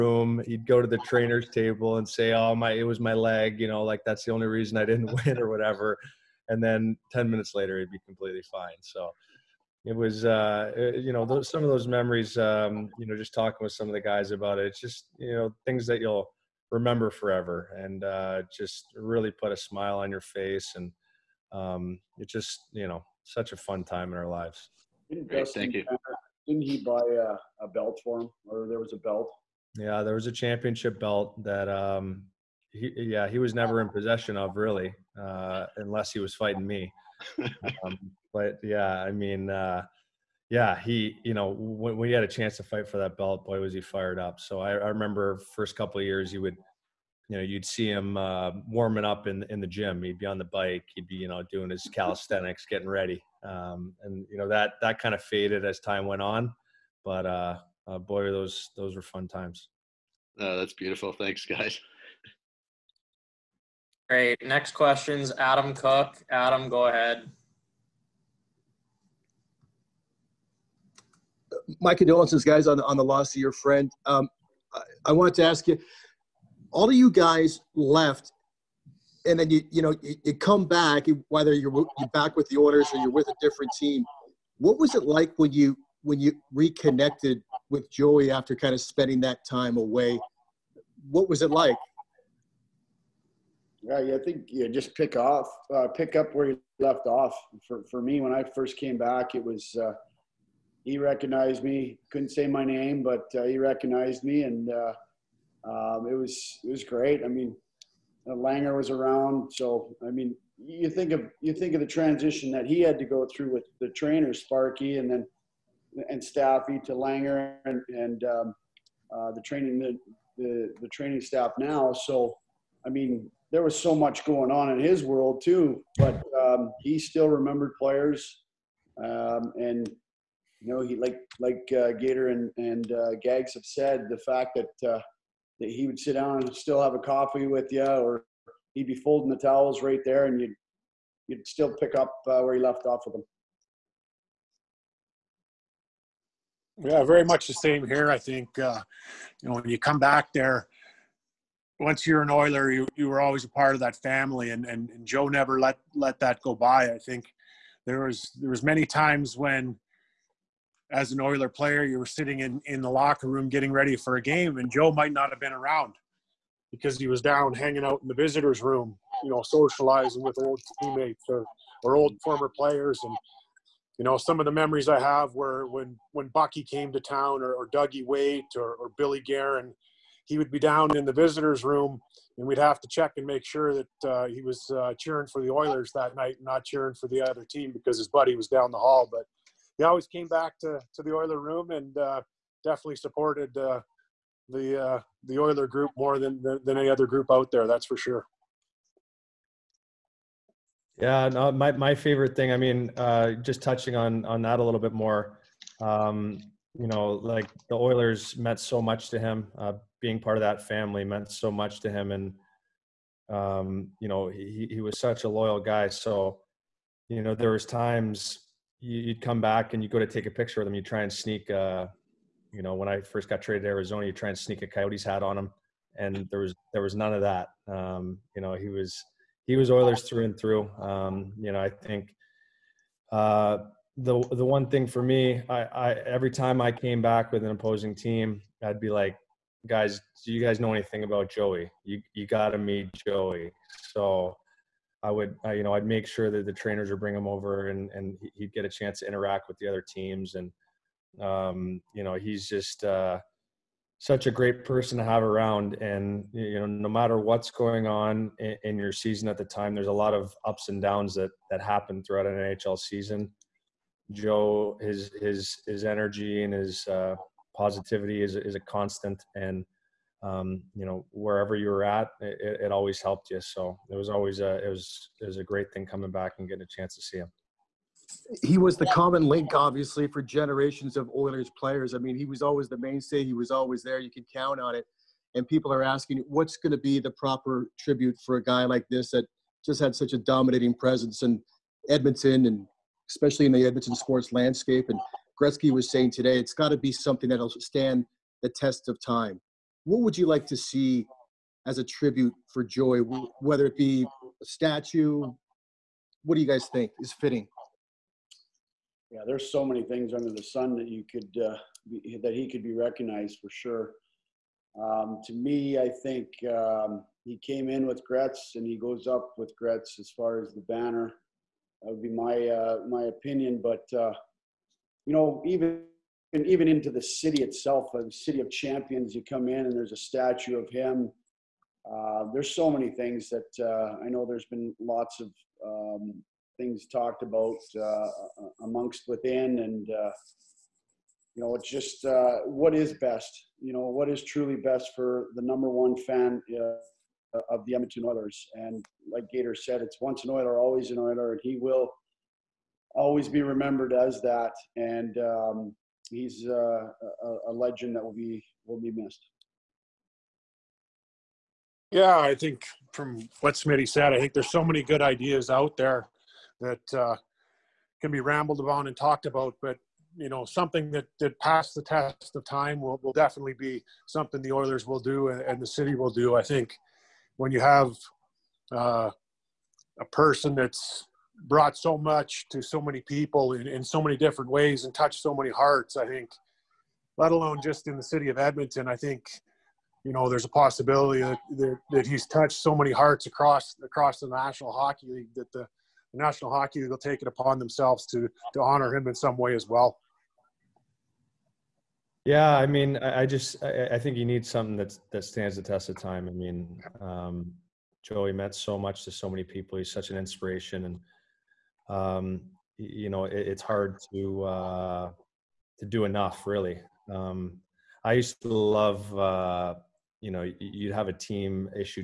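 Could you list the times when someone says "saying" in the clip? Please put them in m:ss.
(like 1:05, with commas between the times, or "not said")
4:55.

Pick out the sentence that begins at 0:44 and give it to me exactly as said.
So I, I remember first couple of years, you would, you know, you'd see him uh, warming up in in the gym.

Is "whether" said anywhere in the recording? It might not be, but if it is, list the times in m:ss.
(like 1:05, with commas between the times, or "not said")
1:21, 5:03.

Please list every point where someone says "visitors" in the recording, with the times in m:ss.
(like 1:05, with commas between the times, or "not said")
2:48, 3:01.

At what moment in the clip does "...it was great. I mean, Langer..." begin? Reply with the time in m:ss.
1:46.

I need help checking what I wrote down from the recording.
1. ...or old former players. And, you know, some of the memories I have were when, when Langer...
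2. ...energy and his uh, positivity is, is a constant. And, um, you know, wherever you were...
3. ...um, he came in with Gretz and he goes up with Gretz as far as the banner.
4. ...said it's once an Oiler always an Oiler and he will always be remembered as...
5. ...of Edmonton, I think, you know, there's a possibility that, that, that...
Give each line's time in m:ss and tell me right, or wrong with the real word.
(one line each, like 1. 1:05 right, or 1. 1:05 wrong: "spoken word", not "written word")
1. 2:51 wrong: "Bucky", not "Langer"
2. 4:25 right
3. 5:16 right
4. 5:49 right
5. 6:28 right.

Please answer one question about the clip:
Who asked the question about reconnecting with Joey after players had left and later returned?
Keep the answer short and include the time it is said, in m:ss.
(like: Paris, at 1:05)
Adam Cook, at 1:05.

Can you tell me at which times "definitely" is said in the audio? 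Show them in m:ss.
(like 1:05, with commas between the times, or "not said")
3:12, 6:13.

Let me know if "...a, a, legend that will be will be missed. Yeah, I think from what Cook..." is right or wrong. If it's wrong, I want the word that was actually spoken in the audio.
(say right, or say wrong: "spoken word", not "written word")
wrong: "Smitty", not "Cook".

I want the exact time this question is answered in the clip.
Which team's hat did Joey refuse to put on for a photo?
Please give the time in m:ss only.
3:44.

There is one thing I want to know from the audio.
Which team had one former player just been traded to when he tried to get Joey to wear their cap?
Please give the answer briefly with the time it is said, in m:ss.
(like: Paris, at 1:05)
Arizona, at 3:43.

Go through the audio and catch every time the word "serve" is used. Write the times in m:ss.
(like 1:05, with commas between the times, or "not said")
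not said.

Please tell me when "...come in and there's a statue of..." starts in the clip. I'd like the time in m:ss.
5:29.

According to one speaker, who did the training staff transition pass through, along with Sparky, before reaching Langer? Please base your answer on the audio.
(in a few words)
Staffy.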